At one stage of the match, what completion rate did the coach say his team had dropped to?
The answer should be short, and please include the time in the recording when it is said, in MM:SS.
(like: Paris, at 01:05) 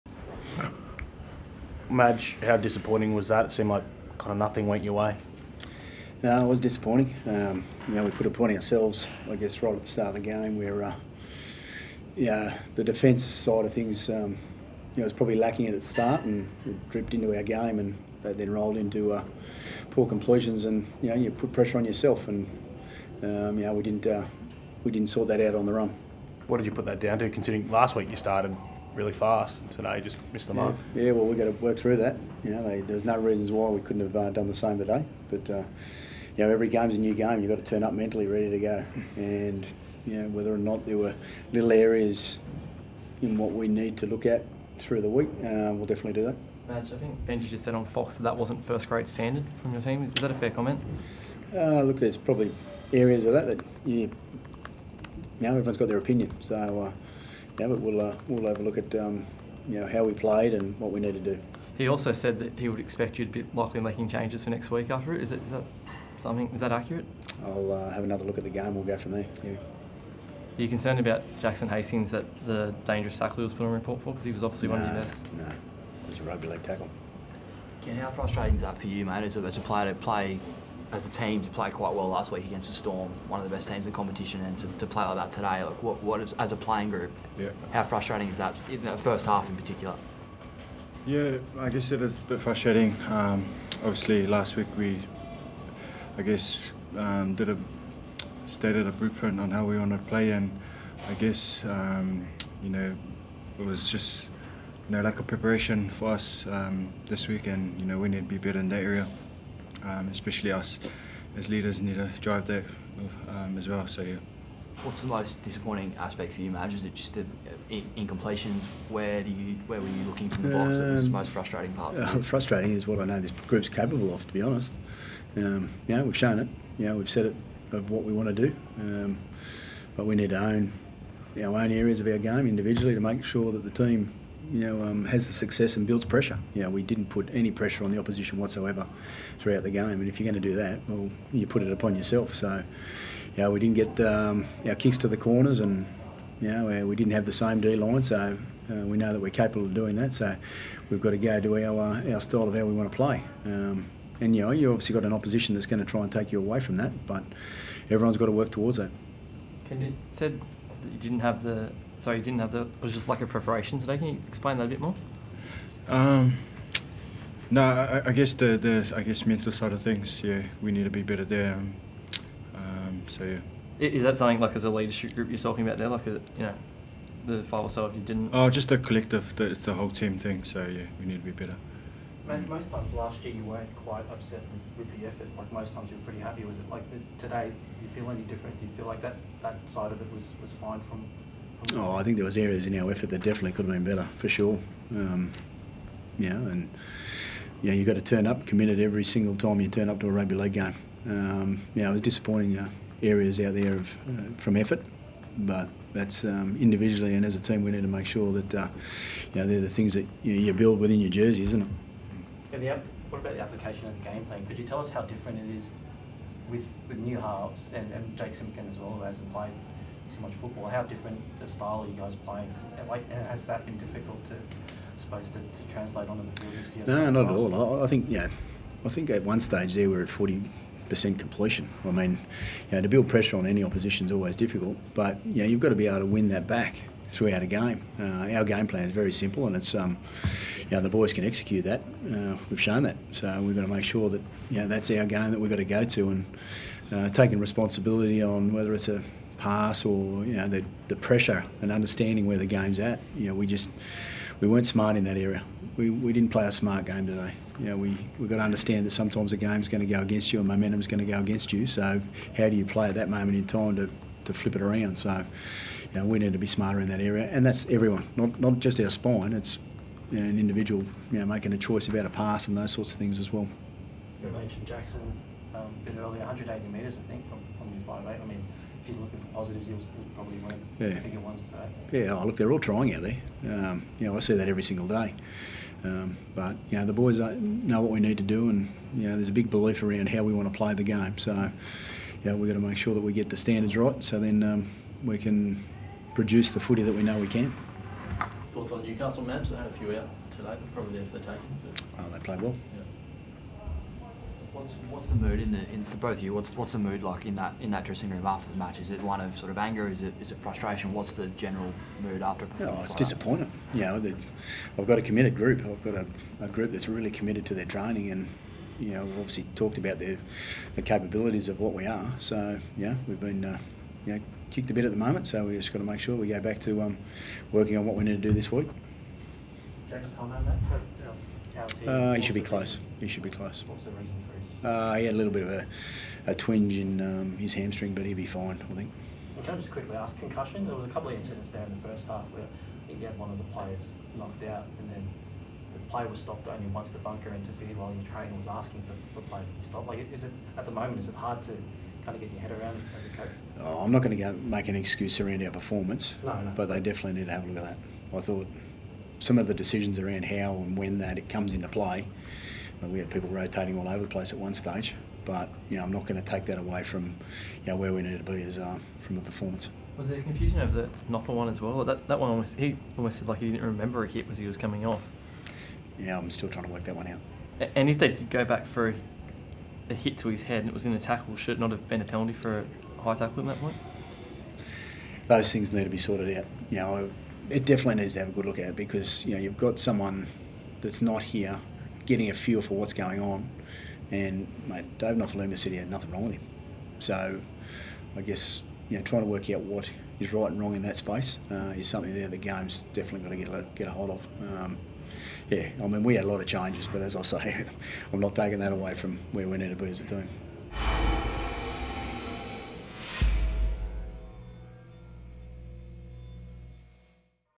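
40%, at 03:50.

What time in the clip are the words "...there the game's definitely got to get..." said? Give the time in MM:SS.
06:42.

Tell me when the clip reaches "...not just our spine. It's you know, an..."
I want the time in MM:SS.
04:28.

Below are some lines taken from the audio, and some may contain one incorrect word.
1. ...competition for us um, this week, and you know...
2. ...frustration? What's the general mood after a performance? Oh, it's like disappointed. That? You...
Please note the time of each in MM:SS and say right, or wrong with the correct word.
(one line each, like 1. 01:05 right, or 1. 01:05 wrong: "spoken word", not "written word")
1. 01:45 wrong: "preparation", not "competition"
2. 05:10 right.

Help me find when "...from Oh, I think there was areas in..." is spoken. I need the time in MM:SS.
03:10.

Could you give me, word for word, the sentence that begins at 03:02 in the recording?
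most times last year you weren't quite upset with, with, the effort.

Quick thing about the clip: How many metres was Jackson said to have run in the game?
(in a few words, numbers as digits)
180.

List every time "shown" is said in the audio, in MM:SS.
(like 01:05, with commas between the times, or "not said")
02:06, 04:02.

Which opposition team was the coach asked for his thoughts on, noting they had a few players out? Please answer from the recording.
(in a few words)
Newcastle.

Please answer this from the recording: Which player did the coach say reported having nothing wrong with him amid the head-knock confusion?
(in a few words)
Dave Nofoaluma.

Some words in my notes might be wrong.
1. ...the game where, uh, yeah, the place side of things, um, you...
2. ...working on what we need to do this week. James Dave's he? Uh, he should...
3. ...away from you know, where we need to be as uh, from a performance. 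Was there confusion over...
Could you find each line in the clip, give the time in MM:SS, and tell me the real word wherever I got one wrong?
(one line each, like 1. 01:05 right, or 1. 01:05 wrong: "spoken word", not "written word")
1. 00:10 wrong: "defence", not "place"
2. 05:27 wrong: "How", not "Dave"
3. 06:06 right.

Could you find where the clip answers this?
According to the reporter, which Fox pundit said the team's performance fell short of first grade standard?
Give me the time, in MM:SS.
00:47.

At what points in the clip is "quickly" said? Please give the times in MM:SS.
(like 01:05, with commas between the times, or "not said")
05:39.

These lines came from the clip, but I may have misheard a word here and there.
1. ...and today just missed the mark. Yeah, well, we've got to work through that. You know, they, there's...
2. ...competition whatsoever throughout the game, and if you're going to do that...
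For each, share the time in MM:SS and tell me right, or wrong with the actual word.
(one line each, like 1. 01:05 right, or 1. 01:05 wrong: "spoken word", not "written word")
1. 00:29 right
2. 02:17 wrong: "opposition", not "competition".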